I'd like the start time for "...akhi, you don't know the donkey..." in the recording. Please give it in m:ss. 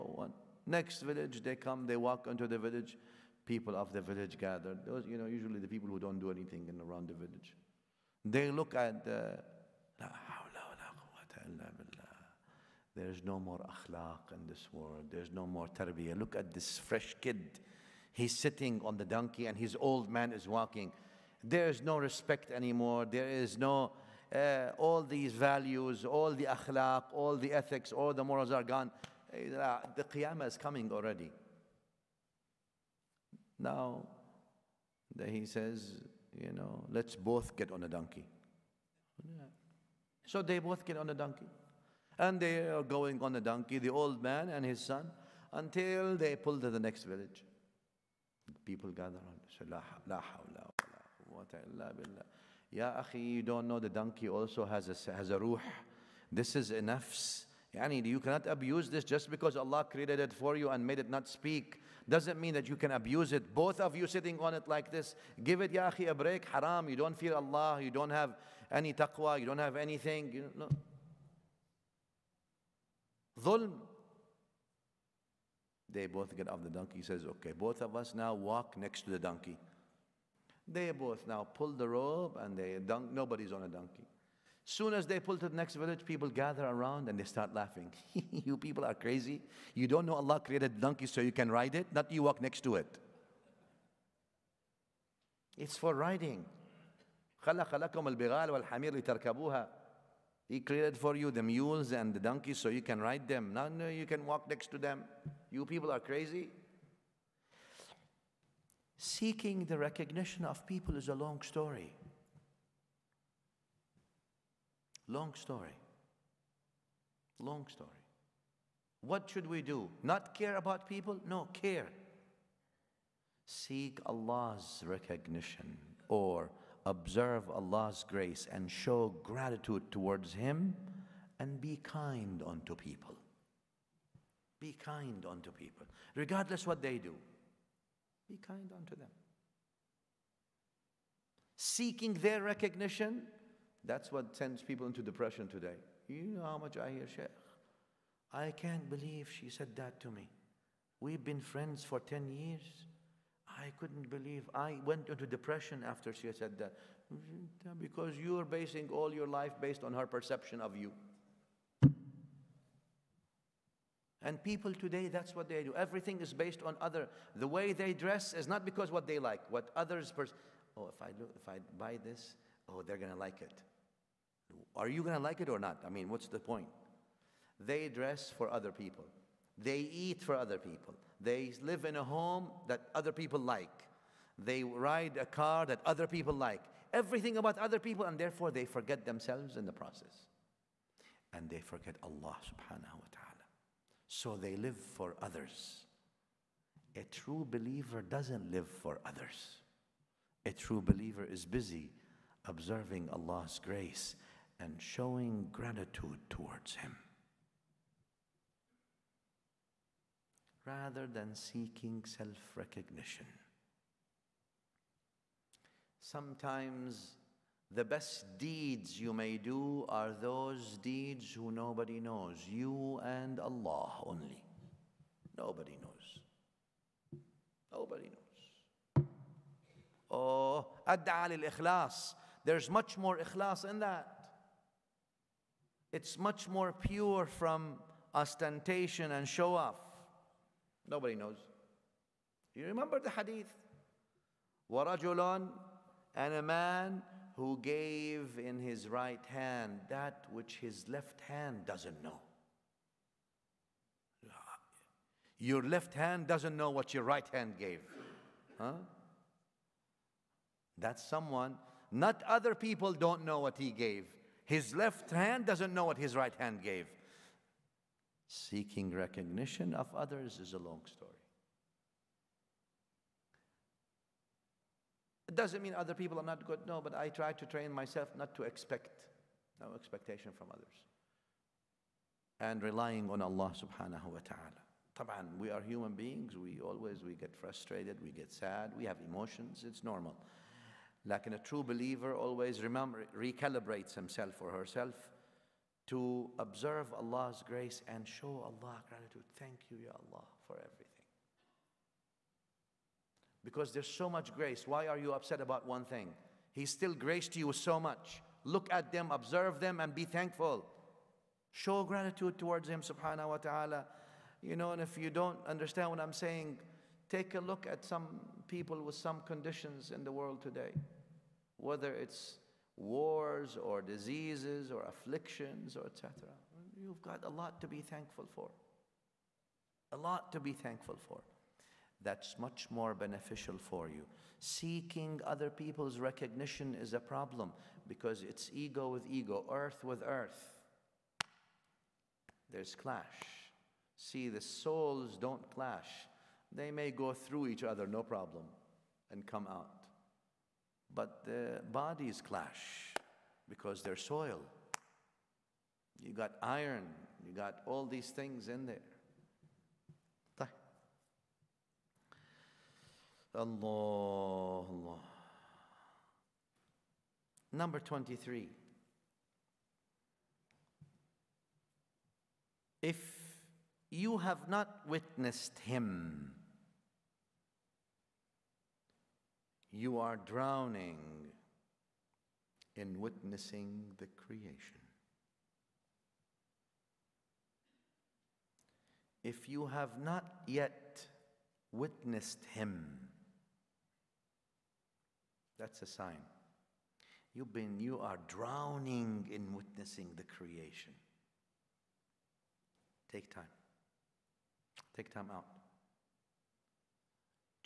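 0:53.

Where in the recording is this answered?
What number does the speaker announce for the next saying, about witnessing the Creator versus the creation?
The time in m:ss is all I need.
6:07.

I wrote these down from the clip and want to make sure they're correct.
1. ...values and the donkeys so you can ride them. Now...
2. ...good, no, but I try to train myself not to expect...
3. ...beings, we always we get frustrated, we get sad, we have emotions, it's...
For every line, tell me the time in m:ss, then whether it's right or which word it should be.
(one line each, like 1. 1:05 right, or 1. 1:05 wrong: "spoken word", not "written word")
1. 1:41 wrong: "mules", not "values"
2. 4:36 right
3. 4:45 right.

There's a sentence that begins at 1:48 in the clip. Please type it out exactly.
Seeking the recognition of people is a long story.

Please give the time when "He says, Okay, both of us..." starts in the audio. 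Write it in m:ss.
1:16.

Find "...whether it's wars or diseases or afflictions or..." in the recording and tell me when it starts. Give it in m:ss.
5:21.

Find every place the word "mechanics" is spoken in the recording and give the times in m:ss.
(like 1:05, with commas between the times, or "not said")
not said.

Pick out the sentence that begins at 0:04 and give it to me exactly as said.
Those, you know, usually the people who don't do anything in around the village.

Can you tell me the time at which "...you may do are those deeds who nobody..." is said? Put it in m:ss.
3:39.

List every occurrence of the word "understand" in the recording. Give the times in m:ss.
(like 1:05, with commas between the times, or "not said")
5:15.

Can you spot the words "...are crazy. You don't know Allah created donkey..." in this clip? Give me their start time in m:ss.
1:28.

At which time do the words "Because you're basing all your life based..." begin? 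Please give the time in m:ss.
2:37.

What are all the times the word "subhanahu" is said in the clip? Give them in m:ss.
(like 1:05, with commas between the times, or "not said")
3:12, 4:43, 5:12.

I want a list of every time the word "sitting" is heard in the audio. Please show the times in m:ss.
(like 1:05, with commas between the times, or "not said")
0:18, 1:04.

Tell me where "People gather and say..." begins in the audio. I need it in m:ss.
0:48.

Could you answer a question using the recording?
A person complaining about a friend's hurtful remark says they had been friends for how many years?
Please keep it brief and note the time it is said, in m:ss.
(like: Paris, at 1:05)
10, at 2:31.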